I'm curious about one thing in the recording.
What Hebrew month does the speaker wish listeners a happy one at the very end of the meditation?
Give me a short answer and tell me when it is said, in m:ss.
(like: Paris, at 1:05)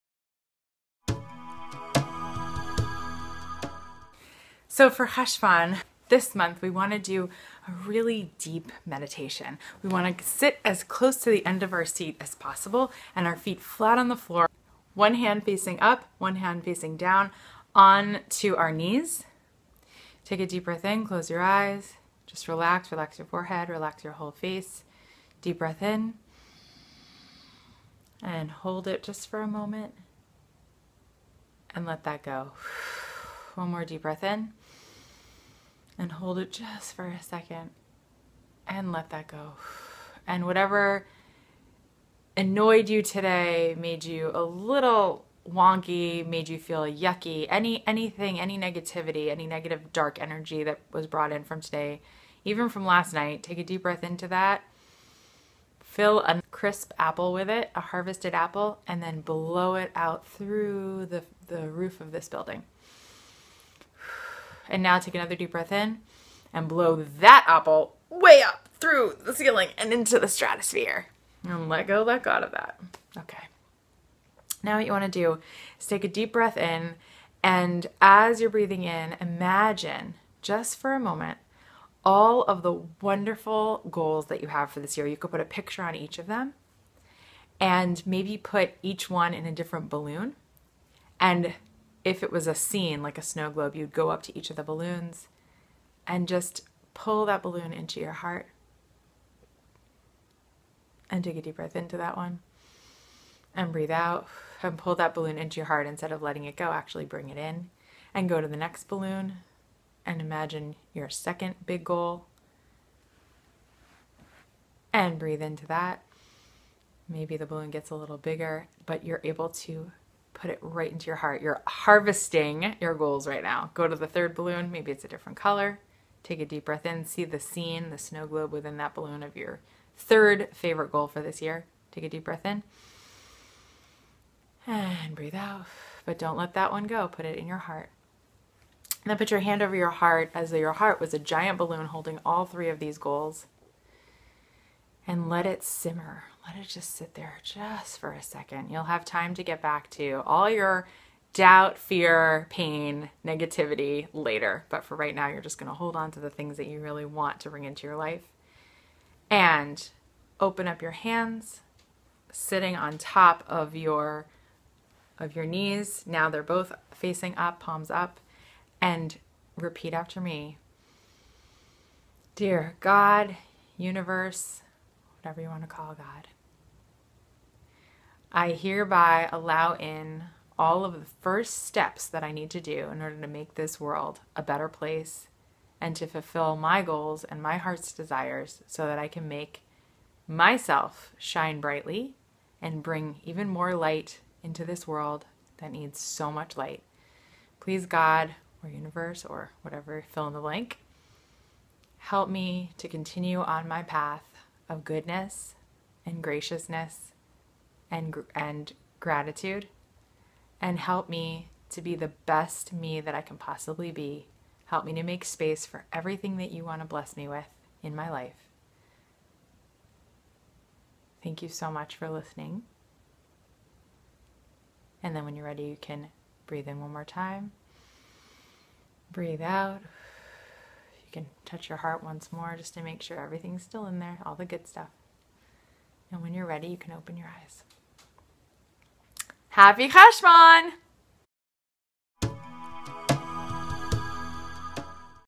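Cheshvan, at 3:59.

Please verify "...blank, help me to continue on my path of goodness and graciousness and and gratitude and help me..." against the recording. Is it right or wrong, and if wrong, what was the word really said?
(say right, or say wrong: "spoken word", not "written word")
right.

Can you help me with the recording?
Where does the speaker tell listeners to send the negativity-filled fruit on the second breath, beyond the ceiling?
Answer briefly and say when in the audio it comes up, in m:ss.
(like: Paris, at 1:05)
The stratosphere, at 1:10.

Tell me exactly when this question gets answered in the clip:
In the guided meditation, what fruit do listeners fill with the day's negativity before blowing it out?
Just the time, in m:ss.
0:56.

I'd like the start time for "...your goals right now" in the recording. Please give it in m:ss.
2:02.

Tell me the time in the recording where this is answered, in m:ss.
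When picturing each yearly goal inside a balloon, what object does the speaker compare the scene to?
1:33.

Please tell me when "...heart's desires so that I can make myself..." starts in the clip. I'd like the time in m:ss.
3:07.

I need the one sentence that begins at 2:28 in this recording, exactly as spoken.
You'll have time to get back to all your doubt, fear, pain, negativity later.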